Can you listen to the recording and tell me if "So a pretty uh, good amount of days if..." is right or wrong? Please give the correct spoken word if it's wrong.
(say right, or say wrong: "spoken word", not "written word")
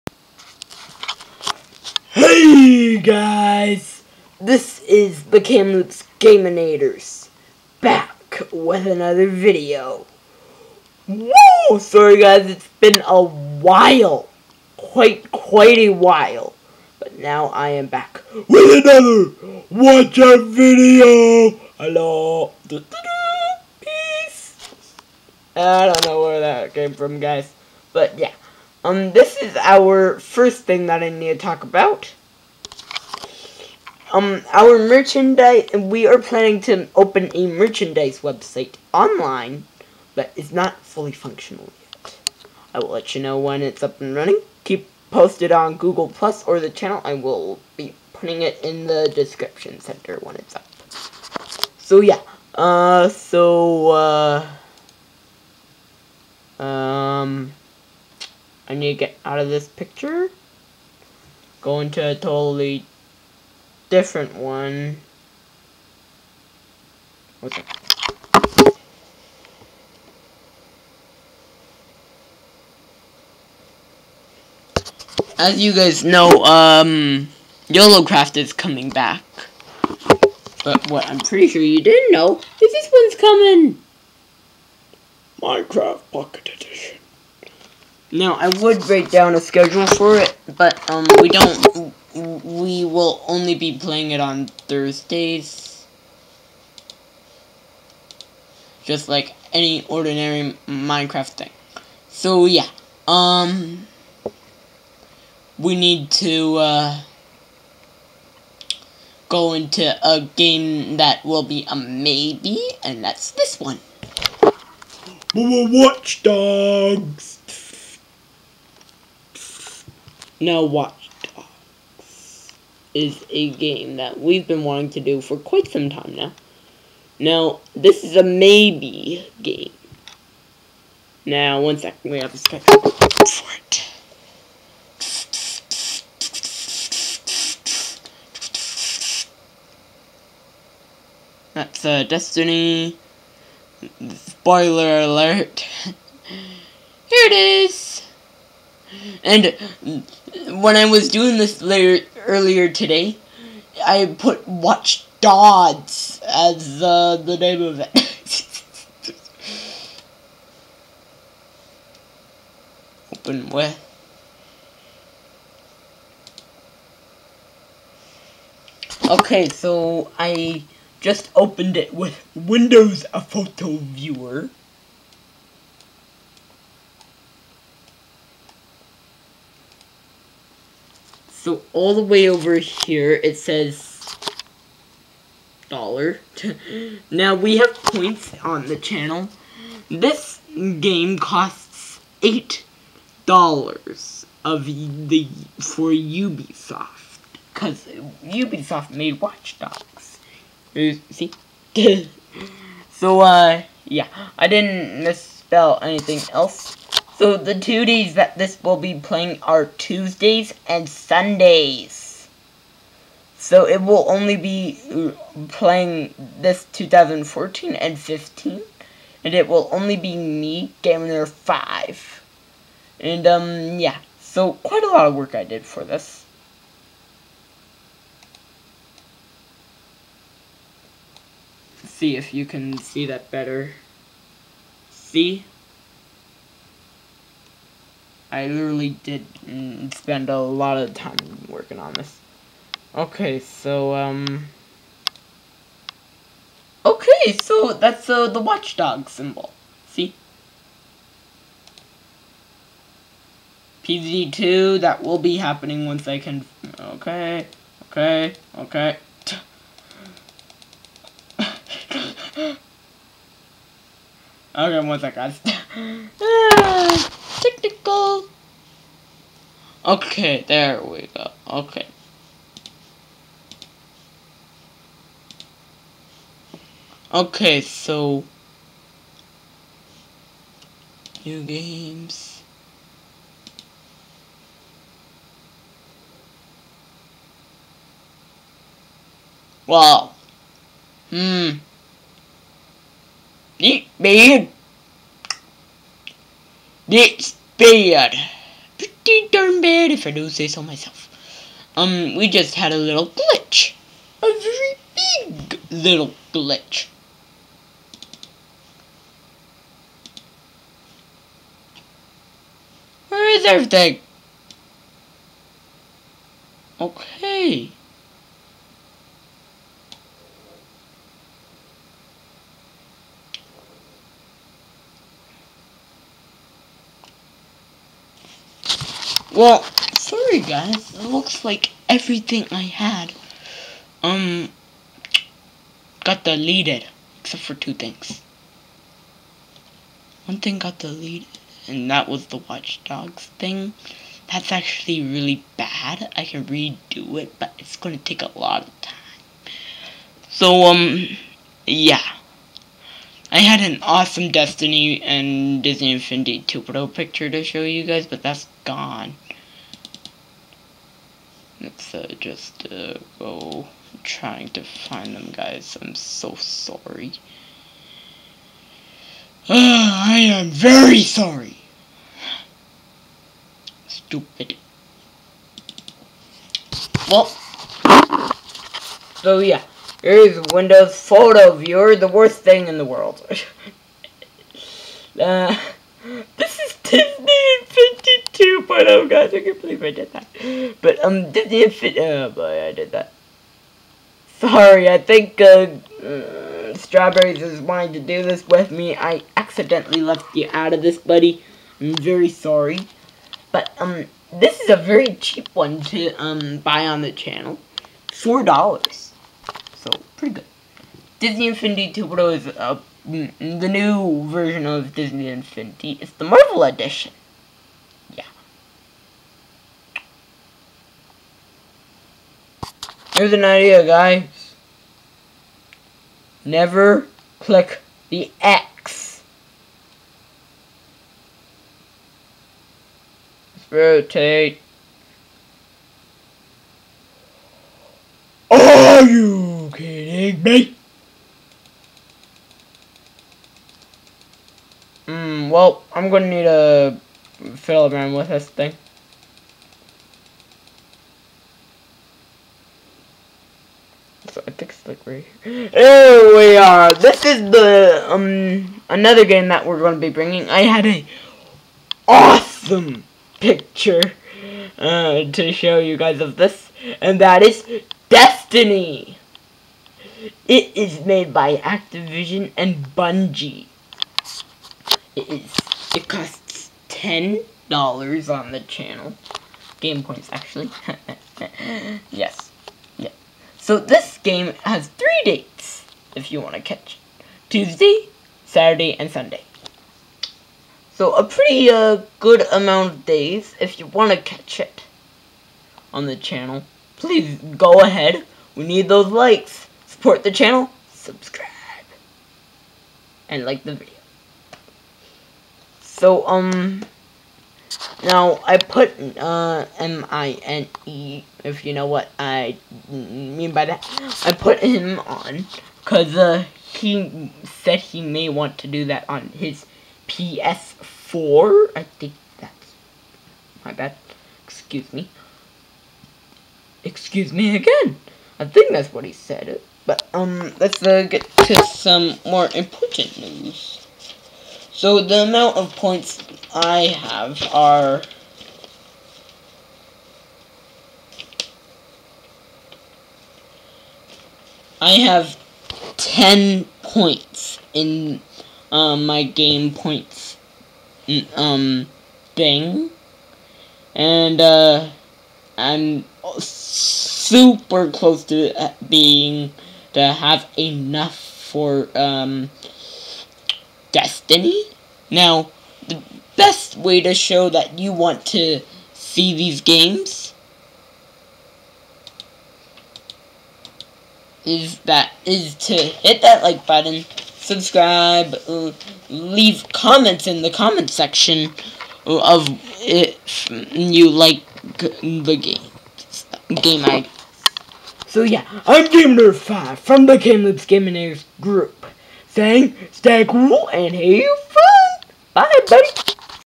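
right.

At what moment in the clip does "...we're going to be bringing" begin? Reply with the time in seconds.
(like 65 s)
459 s.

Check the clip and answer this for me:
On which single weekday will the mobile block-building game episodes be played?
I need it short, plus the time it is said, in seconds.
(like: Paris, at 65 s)
Thursdays, at 94 s.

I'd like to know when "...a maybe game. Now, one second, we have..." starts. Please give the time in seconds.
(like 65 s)
128 s.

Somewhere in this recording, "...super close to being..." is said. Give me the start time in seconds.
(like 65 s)
556 s.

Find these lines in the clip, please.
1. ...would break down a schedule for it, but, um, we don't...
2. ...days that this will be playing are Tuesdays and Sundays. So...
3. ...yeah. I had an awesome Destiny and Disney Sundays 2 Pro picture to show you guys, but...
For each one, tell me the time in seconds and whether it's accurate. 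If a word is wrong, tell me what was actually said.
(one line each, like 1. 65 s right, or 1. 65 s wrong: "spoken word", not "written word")
1. 88 s right
2. 207 s right
3. 351 s wrong: "Infinity", not "Sundays".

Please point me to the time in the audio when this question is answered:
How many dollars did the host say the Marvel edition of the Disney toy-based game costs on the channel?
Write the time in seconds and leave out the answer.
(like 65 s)
408 s.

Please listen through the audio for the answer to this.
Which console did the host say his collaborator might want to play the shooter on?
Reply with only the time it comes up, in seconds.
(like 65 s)
520 s.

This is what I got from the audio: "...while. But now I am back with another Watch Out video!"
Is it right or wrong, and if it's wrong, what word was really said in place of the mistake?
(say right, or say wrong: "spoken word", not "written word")
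right.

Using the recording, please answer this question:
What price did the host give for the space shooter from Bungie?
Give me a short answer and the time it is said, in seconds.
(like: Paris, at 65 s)
10 dollars, at 476 s.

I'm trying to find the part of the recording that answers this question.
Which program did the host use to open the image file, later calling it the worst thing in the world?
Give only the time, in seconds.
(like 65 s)
172 s.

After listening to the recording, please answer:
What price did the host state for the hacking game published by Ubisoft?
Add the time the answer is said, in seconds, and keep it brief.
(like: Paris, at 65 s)
8 dollars, at 192 s.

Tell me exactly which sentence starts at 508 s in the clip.
Now, I put, uh, M-I-N-E, if you know what I mean by that.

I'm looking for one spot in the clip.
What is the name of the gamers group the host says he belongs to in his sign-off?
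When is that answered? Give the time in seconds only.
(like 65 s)
590 s.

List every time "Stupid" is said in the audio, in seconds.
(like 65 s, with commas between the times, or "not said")
373 s.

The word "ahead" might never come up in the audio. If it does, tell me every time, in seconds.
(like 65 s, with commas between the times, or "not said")
497 s.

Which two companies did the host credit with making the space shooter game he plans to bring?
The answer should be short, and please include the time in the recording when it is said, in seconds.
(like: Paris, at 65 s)
Activision and Bungie, at 471 s.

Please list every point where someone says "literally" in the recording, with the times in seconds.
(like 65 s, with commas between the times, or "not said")
238 s.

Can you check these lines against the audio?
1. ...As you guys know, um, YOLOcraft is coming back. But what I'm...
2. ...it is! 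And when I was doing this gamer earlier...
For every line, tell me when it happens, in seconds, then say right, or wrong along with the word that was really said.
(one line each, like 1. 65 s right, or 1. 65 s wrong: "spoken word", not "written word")
1. 75 s right
2. 147 s wrong: "later", not "gamer".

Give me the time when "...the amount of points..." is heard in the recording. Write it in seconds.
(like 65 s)
535 s.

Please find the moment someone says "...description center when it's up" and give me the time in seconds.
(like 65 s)
49 s.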